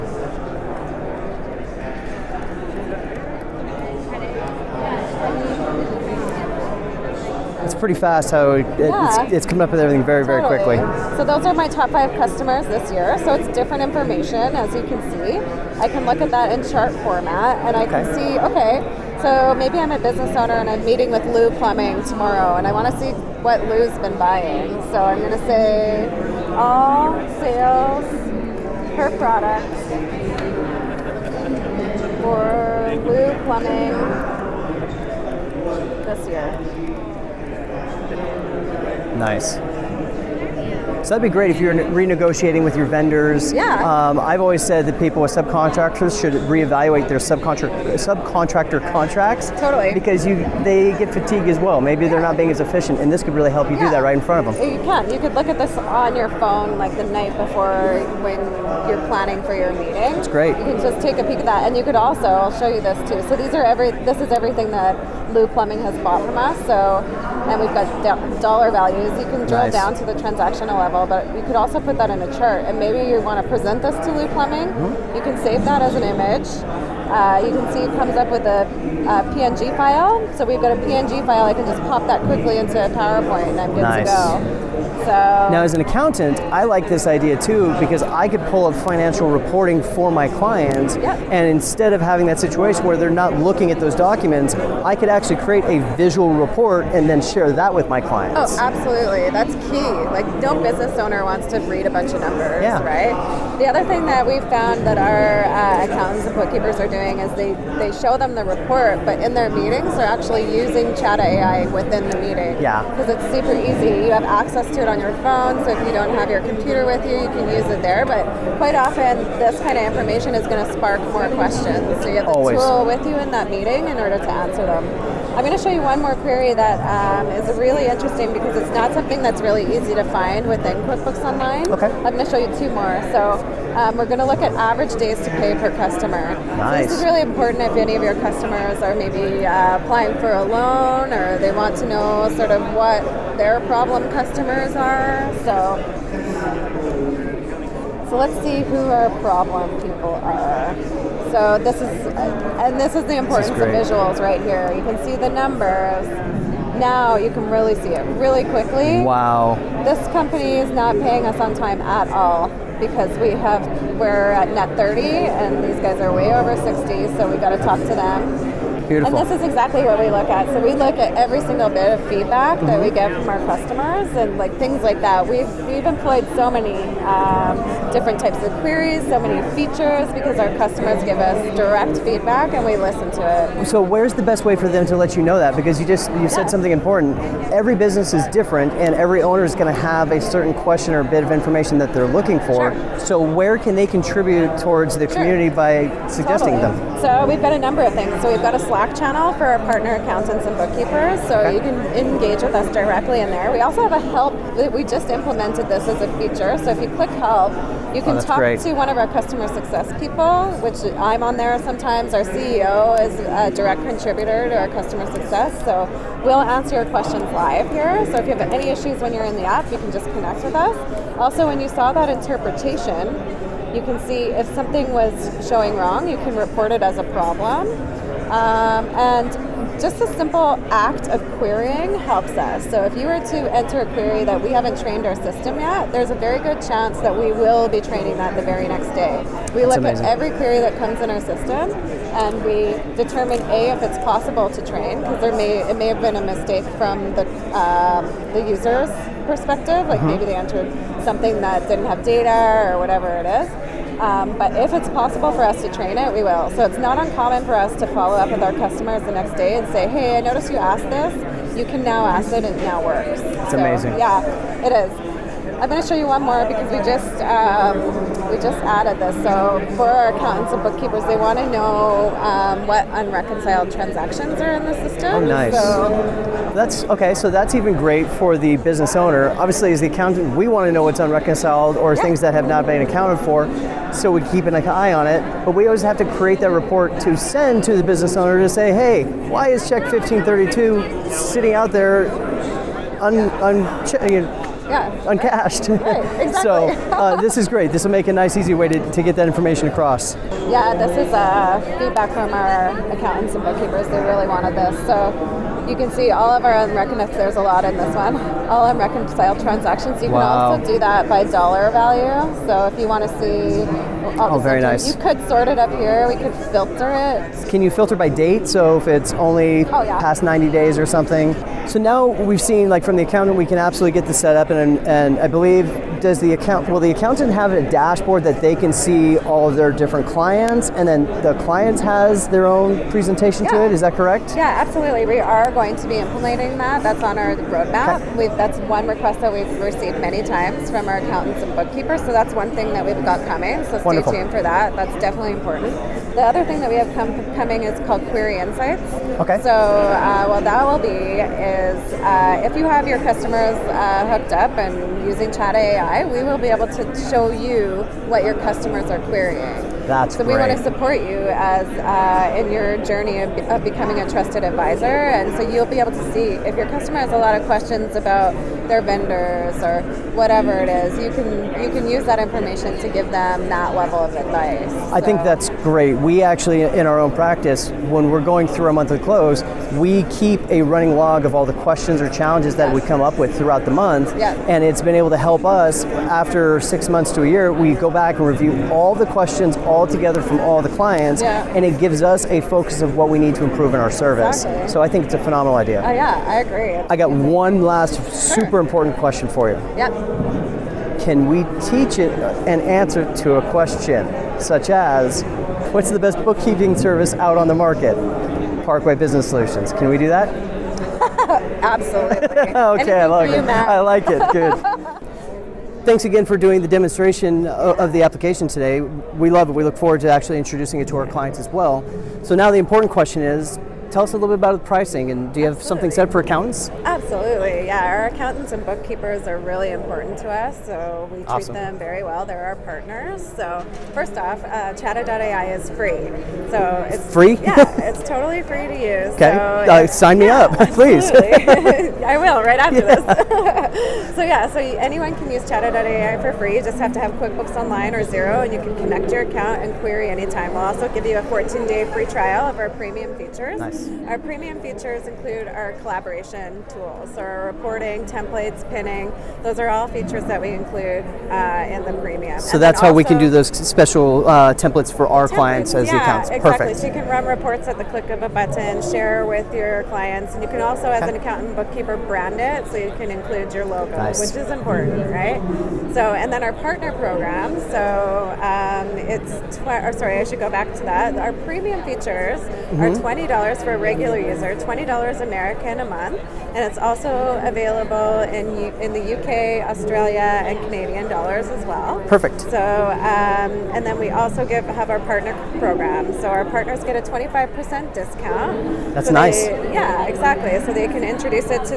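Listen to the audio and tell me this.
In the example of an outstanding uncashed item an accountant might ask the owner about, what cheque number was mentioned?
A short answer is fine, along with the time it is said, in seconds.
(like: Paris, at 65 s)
1532, at 289 s.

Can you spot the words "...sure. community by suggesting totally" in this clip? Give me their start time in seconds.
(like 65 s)
195 s.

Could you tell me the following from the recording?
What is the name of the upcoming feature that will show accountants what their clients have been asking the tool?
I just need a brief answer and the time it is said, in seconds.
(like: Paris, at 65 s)
query insights, at 348 s.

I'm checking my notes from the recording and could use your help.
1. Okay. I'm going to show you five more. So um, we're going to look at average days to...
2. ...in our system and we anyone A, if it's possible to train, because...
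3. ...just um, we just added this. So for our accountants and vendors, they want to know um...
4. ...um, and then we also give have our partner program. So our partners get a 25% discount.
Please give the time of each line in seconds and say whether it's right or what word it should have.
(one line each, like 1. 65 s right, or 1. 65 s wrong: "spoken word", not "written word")
1. 131 s wrong: "two", not "five"
2. 241 s wrong: "determine", not "anyone"
3. 266 s wrong: "bookkeepers", not "vendors"
4. 493 s right.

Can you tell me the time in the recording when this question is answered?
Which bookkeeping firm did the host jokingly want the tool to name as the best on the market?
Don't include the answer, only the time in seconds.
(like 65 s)
408 s.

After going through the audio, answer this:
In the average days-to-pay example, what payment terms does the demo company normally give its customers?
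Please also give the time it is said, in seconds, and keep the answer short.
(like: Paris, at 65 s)
net 30, at 164 s.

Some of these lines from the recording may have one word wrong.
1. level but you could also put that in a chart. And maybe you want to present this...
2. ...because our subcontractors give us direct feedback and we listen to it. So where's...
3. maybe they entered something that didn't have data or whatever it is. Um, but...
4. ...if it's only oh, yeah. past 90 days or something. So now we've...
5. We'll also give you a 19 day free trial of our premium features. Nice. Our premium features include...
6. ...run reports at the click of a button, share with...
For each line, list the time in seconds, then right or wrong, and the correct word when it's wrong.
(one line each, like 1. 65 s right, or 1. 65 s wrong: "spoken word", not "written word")
1. 70 s right
2. 180 s wrong: "customers", not "subcontractors"
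3. 250 s right
4. 318 s right
5. 450 s wrong: "14", not "19"
6. 467 s right.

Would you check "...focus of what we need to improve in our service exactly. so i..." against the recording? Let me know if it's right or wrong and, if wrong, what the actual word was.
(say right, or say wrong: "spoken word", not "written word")
right.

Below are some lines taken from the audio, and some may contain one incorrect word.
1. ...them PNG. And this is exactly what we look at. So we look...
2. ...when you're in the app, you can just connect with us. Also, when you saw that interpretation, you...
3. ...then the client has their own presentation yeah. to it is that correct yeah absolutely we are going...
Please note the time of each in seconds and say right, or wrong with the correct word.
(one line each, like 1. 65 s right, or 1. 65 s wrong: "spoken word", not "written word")
1. 168 s wrong: "Beautiful", not "PNG"
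2. 218 s right
3. 330 s right.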